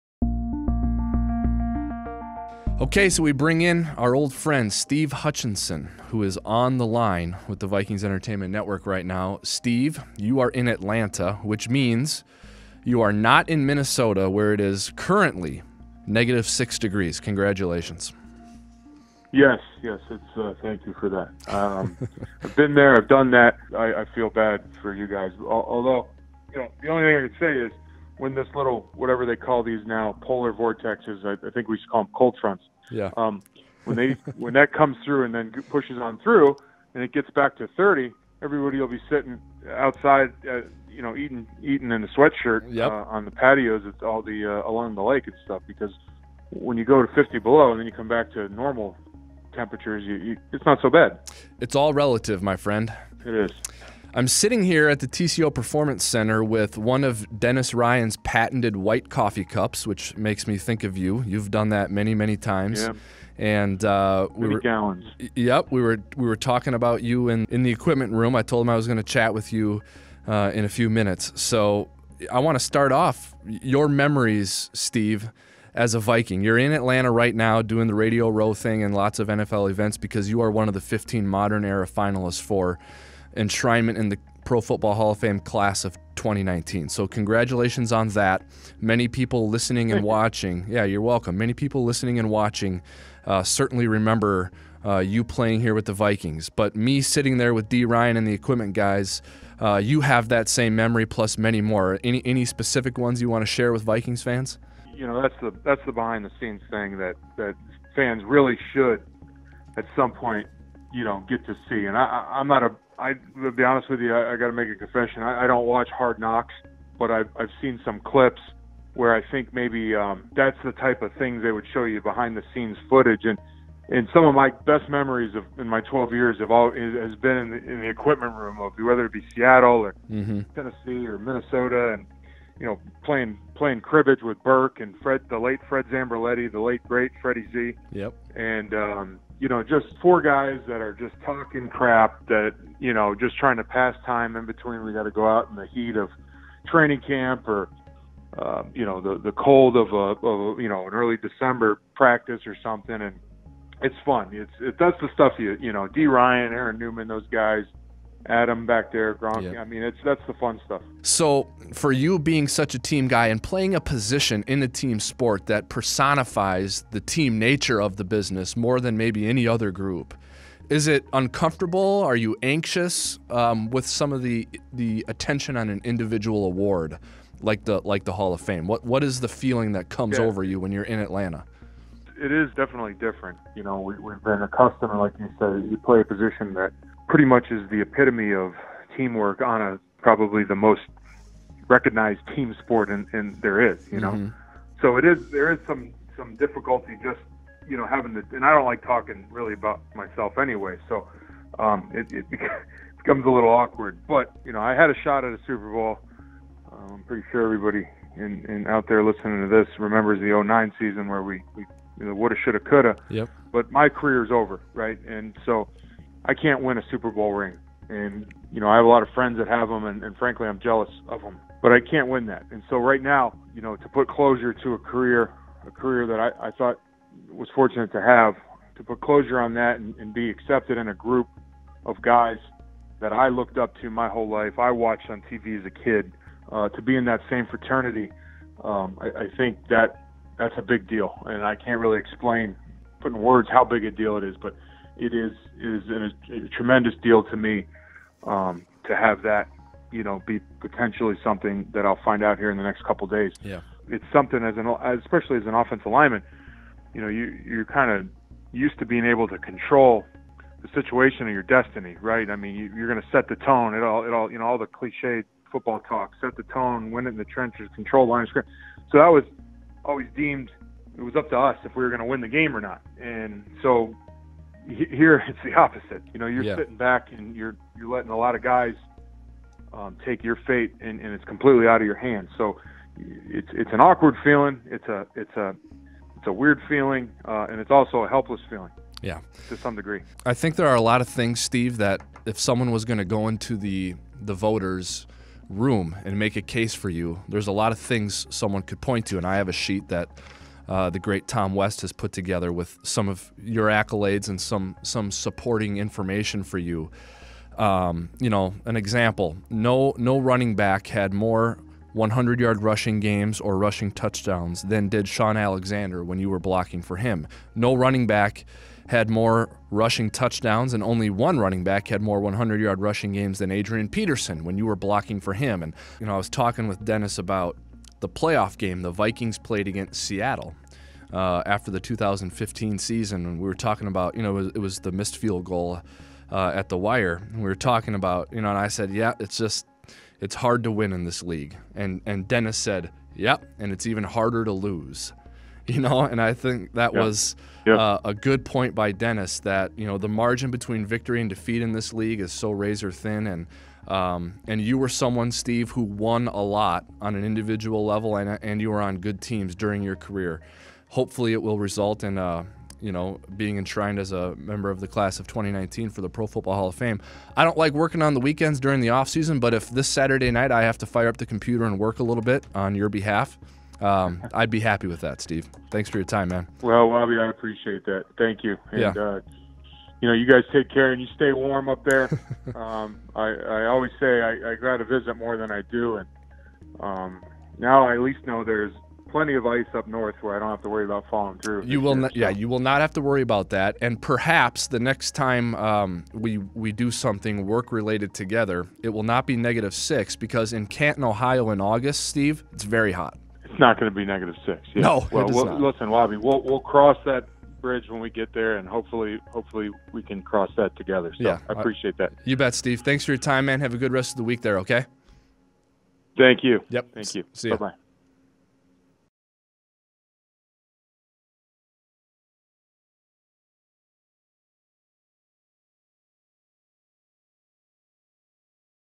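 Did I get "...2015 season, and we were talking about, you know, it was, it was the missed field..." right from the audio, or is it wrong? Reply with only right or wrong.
right.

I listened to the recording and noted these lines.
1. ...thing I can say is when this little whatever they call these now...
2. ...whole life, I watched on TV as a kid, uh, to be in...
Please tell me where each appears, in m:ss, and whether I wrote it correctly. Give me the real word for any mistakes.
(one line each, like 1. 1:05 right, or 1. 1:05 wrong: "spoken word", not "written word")
1. 0:27 right
2. 3:54 right.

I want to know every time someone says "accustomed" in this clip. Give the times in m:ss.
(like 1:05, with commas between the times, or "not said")
3:04.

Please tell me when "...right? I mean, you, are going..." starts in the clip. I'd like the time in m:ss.
4:22.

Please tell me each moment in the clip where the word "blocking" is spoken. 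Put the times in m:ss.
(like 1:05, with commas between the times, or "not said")
5:16, 5:24.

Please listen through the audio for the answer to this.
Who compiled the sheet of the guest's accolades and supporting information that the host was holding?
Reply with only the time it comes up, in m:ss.
5:01.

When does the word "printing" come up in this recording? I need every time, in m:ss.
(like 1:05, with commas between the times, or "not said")
not said.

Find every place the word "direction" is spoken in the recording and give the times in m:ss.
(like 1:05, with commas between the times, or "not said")
not said.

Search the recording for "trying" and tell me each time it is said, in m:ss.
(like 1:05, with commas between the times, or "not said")
2:23.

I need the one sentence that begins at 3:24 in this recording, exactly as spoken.
But you know I had a shot at a Super Bowl.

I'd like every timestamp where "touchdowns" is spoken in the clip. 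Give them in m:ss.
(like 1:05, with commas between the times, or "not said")
5:13, 5:20.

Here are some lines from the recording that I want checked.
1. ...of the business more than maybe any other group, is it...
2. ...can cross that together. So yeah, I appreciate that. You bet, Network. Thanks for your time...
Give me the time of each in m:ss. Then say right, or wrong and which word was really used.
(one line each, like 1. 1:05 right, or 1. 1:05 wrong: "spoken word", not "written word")
1. 2:47 right
2. 6:50 wrong: "Steve", not "Network".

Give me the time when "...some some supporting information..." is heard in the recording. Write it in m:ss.
5:04.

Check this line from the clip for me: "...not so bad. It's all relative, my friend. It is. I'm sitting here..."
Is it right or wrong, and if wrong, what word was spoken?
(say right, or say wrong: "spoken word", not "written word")
right.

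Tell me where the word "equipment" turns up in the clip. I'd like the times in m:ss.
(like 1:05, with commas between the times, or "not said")
1:07, 1:38, 2:07.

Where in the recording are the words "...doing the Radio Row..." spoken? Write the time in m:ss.
1:17.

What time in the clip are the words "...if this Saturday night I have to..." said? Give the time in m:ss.
6:09.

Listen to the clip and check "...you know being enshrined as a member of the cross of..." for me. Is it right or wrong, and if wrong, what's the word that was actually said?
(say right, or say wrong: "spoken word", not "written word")
wrong: "class", not "cross".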